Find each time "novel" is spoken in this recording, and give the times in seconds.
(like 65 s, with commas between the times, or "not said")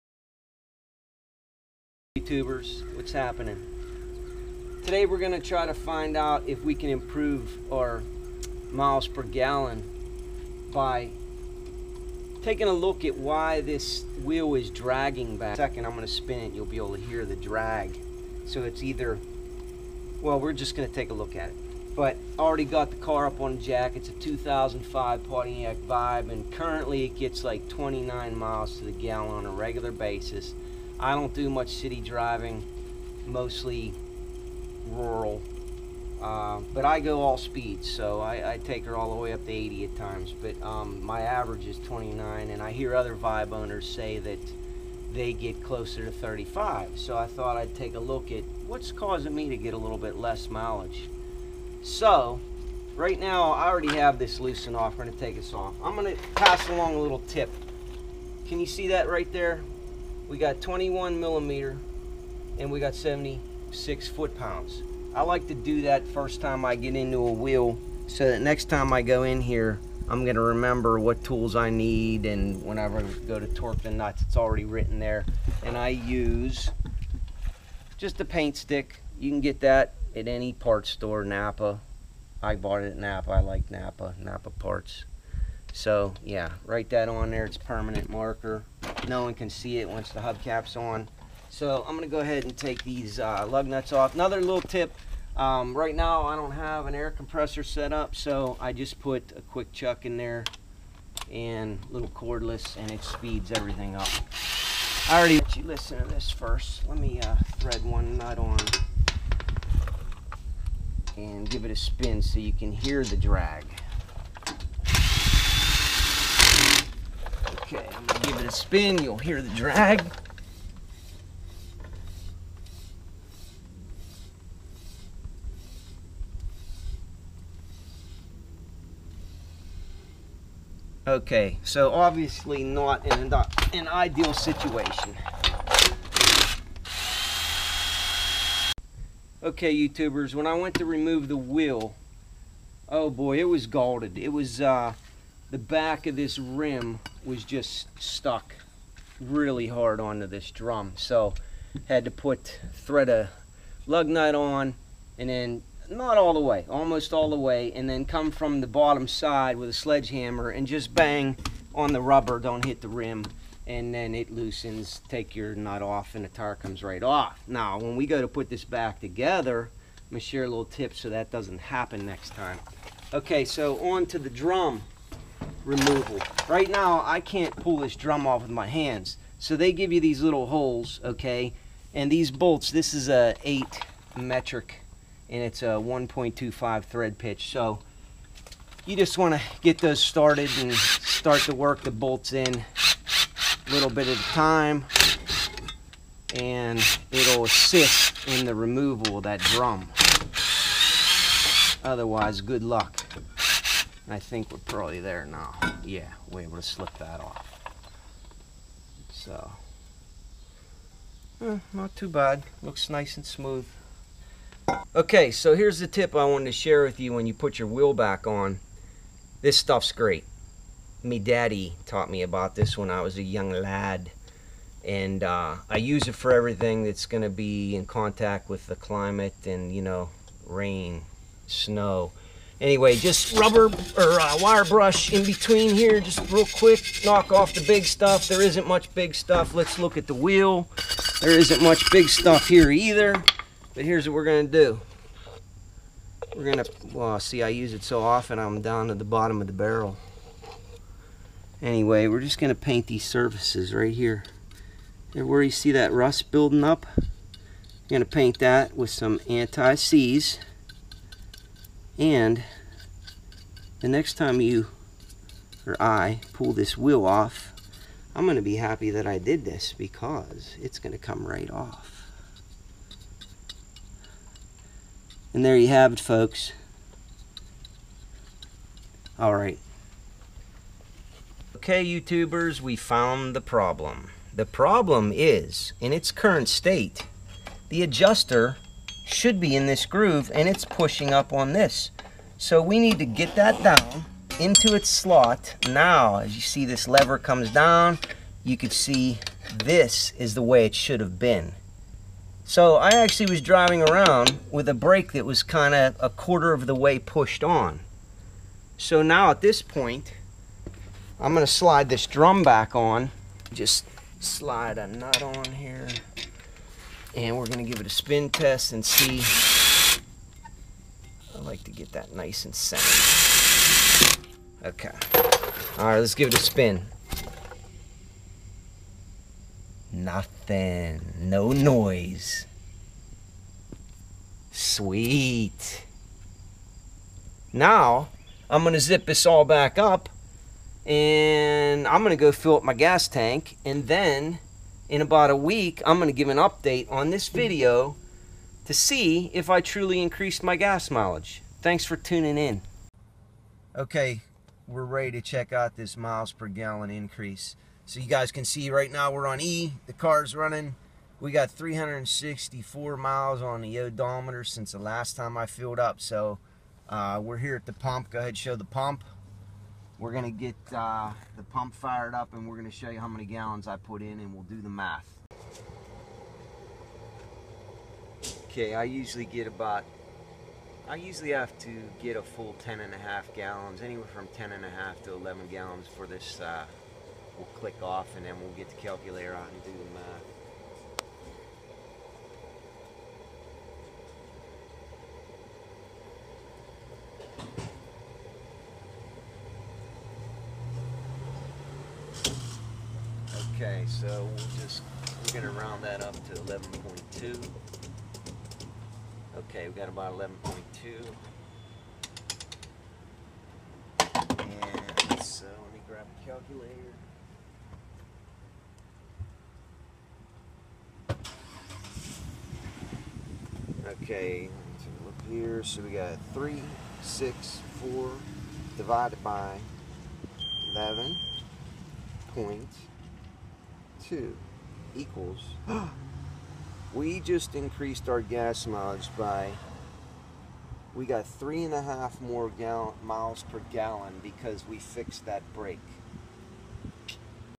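not said.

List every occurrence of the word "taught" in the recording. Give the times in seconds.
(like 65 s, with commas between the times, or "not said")
221 s.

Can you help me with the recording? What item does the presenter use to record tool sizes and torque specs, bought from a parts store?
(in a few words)
A paint stick.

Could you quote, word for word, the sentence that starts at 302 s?
So I actually was driving around with a brake that was kind of a quarter of the way pushed on.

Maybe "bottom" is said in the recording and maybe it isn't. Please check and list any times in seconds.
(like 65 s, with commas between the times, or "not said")
158 s, 249 s.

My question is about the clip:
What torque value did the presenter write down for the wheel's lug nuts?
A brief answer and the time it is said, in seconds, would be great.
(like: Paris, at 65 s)
76 foot-pounds, at 62 s.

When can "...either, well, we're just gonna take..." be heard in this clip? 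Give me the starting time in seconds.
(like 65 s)
18 s.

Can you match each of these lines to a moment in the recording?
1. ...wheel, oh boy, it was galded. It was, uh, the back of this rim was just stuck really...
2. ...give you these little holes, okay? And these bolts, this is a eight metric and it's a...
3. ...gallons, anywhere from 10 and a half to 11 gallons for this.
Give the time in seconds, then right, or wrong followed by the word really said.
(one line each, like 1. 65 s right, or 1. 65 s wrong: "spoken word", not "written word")
1. 141 s right
2. 179 s right
3. 383 s right.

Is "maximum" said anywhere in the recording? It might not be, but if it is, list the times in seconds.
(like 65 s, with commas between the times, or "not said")
not said.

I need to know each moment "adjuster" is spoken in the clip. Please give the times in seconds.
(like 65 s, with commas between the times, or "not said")
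287 s.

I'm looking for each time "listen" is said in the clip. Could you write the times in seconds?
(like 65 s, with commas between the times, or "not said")
105 s.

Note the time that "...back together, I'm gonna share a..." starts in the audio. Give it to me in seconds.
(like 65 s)
168 s.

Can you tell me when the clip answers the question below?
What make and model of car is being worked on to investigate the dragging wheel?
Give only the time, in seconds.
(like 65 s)
24 s.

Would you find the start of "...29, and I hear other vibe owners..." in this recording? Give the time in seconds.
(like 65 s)
41 s.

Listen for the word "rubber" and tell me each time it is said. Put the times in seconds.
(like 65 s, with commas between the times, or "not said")
162 s, 233 s.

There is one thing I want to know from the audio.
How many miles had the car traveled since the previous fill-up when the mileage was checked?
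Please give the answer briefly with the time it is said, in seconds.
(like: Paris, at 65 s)
364, at 361 s.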